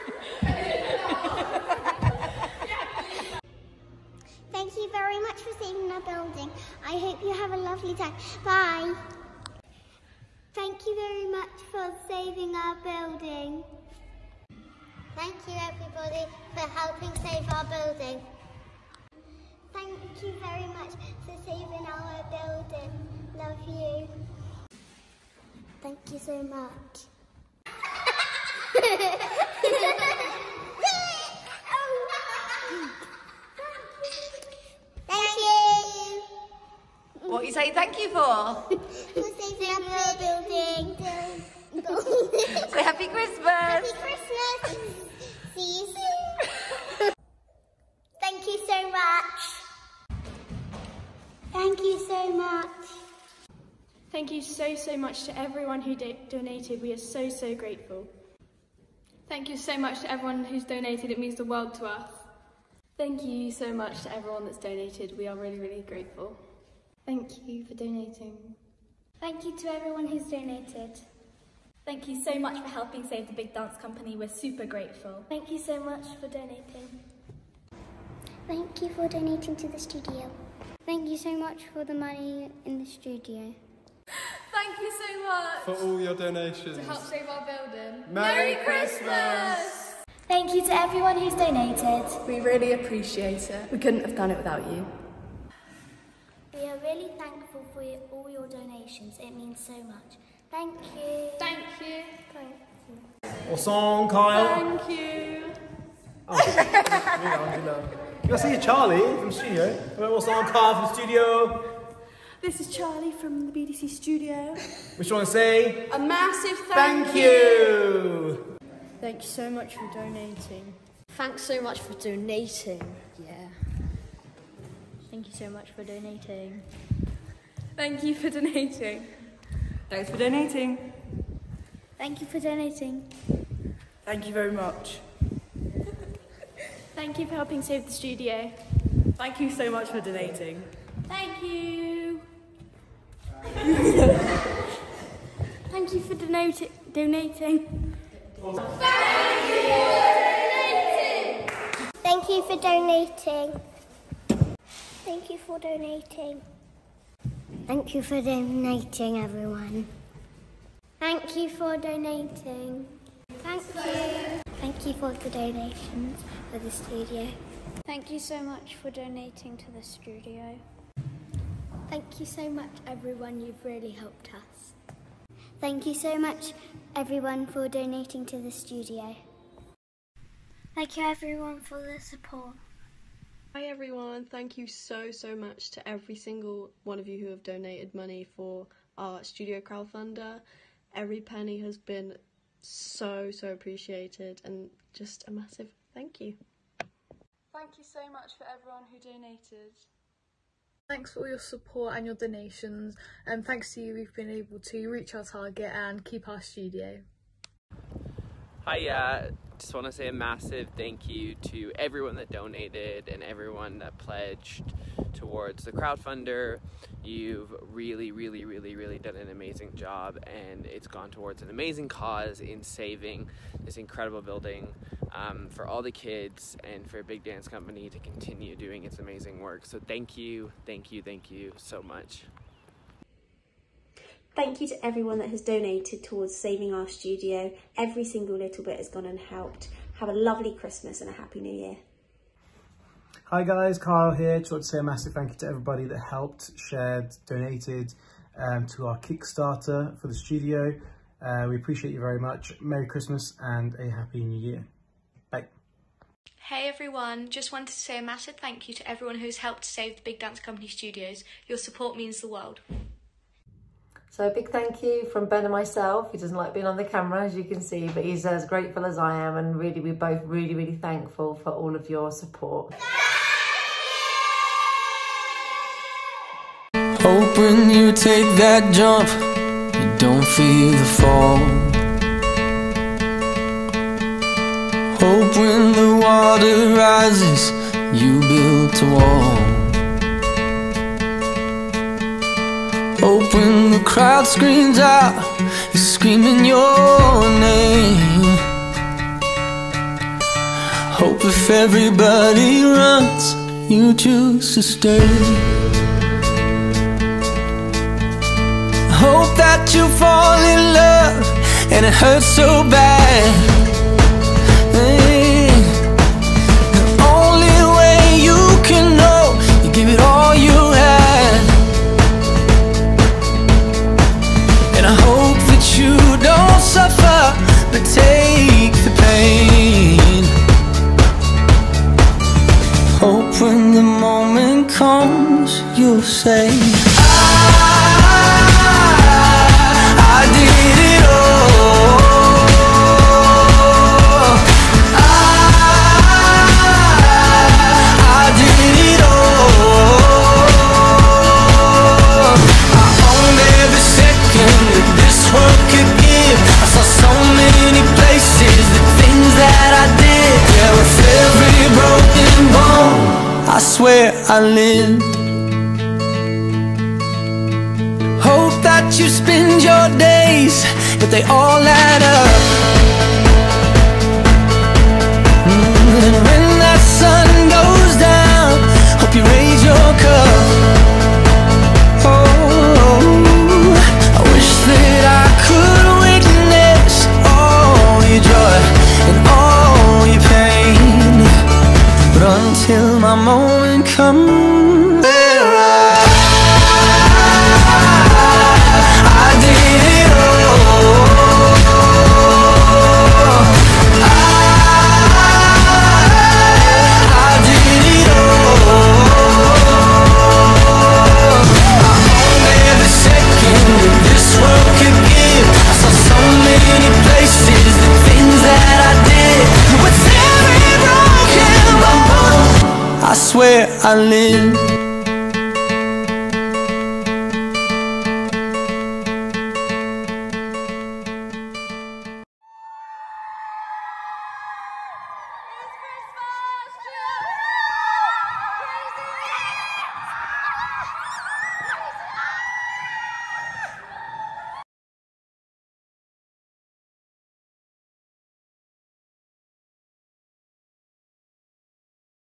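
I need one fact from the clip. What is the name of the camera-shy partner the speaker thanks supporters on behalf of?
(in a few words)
Ben.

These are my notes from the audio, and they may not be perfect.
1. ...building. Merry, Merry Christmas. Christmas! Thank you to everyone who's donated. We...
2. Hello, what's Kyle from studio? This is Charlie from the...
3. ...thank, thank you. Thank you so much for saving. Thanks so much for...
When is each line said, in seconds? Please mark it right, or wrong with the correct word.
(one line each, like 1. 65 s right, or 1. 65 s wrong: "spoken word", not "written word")
1. 87 s right
2. 109 s right
3. 116 s wrong: "donating", not "saving".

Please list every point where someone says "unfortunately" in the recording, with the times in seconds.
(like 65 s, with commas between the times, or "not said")
not said.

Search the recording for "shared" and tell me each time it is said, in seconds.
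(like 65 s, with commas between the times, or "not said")
246 s.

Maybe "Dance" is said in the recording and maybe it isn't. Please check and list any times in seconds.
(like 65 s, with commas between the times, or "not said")
73 s, 227 s, 260 s.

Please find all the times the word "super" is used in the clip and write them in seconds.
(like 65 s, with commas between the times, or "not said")
74 s.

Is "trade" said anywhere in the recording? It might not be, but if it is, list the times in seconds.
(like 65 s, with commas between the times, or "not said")
not said.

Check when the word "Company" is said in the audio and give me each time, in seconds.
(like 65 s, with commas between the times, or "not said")
73 s, 227 s, 260 s.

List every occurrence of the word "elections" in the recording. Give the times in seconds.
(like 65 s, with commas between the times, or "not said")
not said.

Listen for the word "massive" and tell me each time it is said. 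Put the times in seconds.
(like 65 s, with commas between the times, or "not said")
115 s, 195 s, 210 s, 244 s, 258 s.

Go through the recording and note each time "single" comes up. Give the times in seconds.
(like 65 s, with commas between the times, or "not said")
186 s, 238 s.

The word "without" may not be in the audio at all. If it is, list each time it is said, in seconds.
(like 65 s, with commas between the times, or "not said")
94 s.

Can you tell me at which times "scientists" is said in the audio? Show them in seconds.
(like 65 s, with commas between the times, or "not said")
not said.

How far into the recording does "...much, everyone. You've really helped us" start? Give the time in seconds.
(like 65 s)
172 s.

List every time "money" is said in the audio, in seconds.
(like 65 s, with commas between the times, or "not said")
81 s, 187 s.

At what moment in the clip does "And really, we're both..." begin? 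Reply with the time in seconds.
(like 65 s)
269 s.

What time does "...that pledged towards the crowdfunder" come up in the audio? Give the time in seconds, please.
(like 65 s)
213 s.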